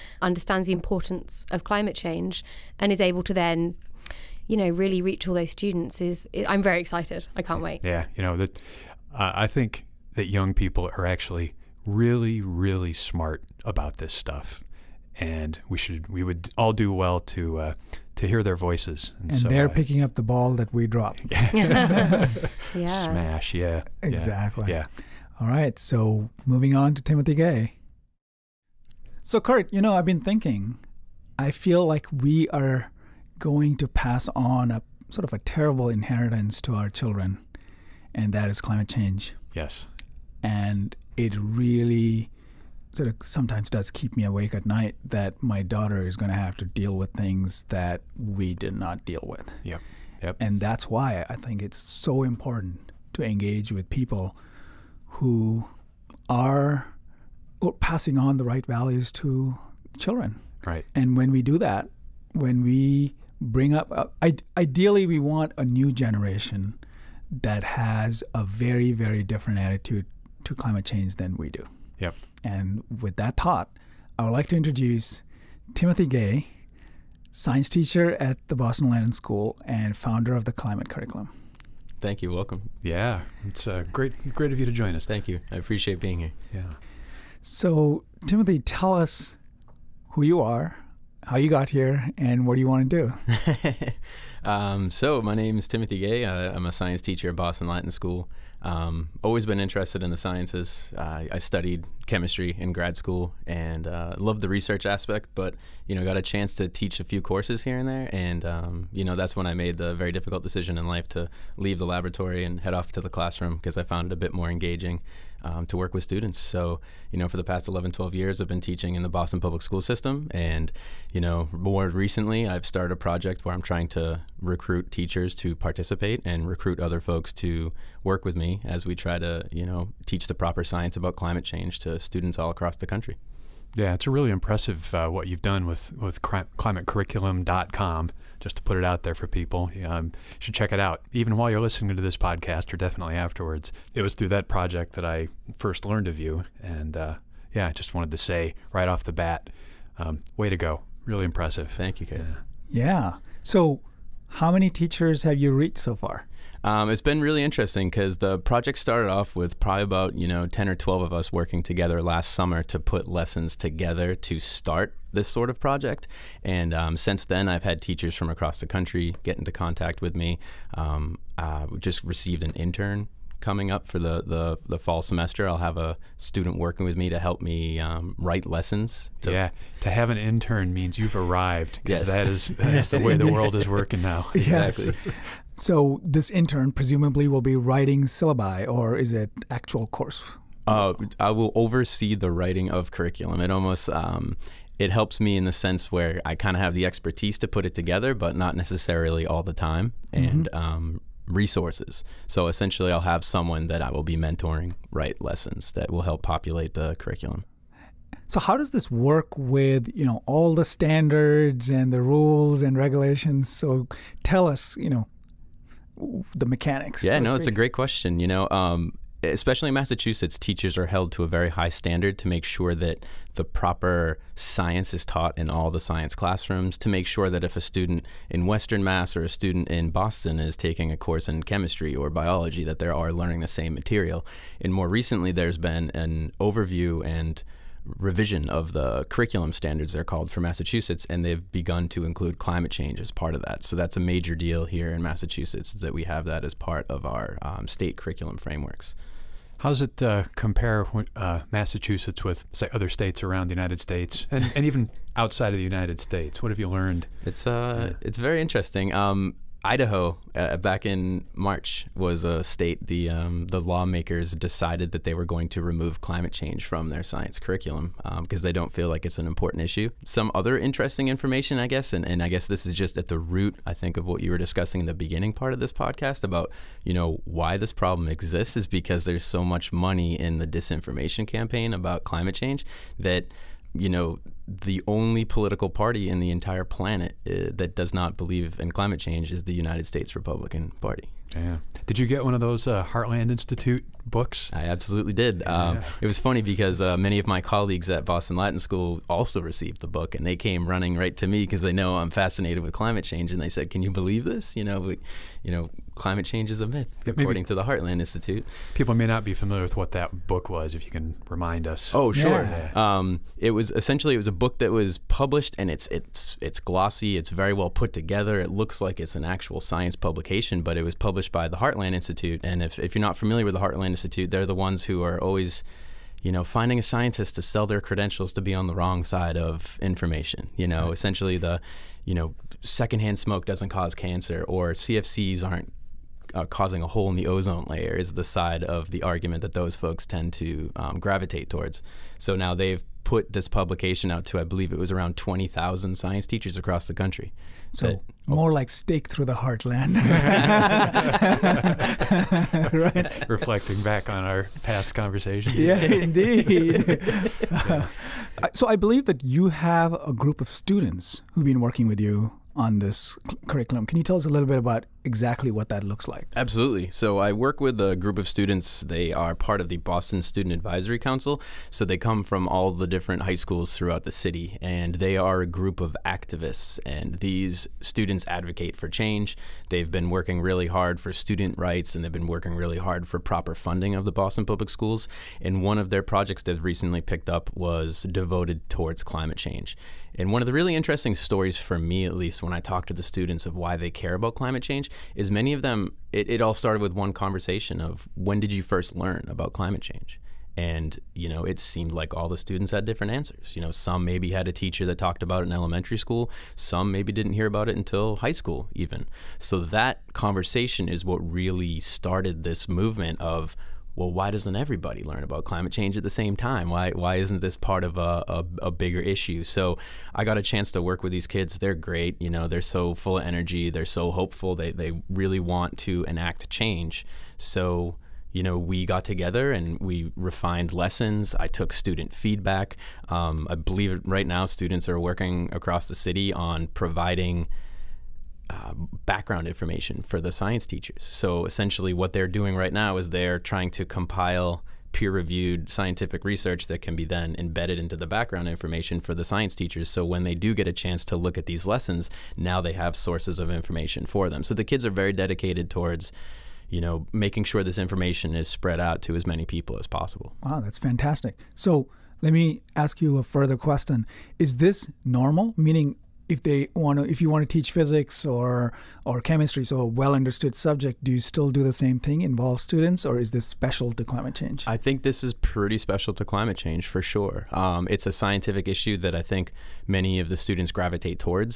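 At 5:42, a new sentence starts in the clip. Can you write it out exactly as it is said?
So now they've put this publication out to, I believe it was around 20,000 science teachers across the country.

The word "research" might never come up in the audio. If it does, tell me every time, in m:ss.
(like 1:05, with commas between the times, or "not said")
1:44, 7:26.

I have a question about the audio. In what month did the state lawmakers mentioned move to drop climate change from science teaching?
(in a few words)
March.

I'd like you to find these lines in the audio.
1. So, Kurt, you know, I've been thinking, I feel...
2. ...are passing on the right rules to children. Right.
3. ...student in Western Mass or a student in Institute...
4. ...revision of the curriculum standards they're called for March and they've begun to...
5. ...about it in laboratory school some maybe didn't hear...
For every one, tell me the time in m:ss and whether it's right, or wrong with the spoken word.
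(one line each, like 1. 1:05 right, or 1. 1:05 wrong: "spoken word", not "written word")
1. 0:29 right
2. 0:56 wrong: "values", not "rules"
3. 3:47 wrong: "Boston", not "Institute"
4. 3:57 wrong: "Massachusetts", not "March"
5. 6:45 wrong: "elementary", not "laboratory".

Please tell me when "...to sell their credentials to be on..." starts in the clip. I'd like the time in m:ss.
5:27.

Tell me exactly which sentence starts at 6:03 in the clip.
Can you tell us a little bit about exactly what that looks like.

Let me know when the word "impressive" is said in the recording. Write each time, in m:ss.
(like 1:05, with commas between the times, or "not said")
2:14, 2:31.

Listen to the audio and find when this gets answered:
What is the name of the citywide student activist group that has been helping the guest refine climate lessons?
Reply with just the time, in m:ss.
6:09.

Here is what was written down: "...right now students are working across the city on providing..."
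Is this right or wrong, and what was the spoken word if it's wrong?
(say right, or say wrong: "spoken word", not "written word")
right.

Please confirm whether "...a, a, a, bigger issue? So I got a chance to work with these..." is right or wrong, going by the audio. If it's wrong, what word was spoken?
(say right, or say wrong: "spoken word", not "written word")
right.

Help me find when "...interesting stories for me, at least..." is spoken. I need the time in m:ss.
6:30.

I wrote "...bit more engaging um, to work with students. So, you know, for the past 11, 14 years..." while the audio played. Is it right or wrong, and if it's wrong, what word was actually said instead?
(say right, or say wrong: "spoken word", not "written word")
wrong: "12", not "14".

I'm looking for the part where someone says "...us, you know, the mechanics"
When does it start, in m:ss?
3:34.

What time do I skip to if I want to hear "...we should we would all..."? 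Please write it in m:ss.
0:15.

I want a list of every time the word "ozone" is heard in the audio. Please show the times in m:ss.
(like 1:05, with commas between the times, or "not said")
5:37.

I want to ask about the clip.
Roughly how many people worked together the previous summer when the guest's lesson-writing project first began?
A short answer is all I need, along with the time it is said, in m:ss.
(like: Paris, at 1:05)
10 or 12, at 2:40.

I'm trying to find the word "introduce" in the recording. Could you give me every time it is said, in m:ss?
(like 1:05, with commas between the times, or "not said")
1:14.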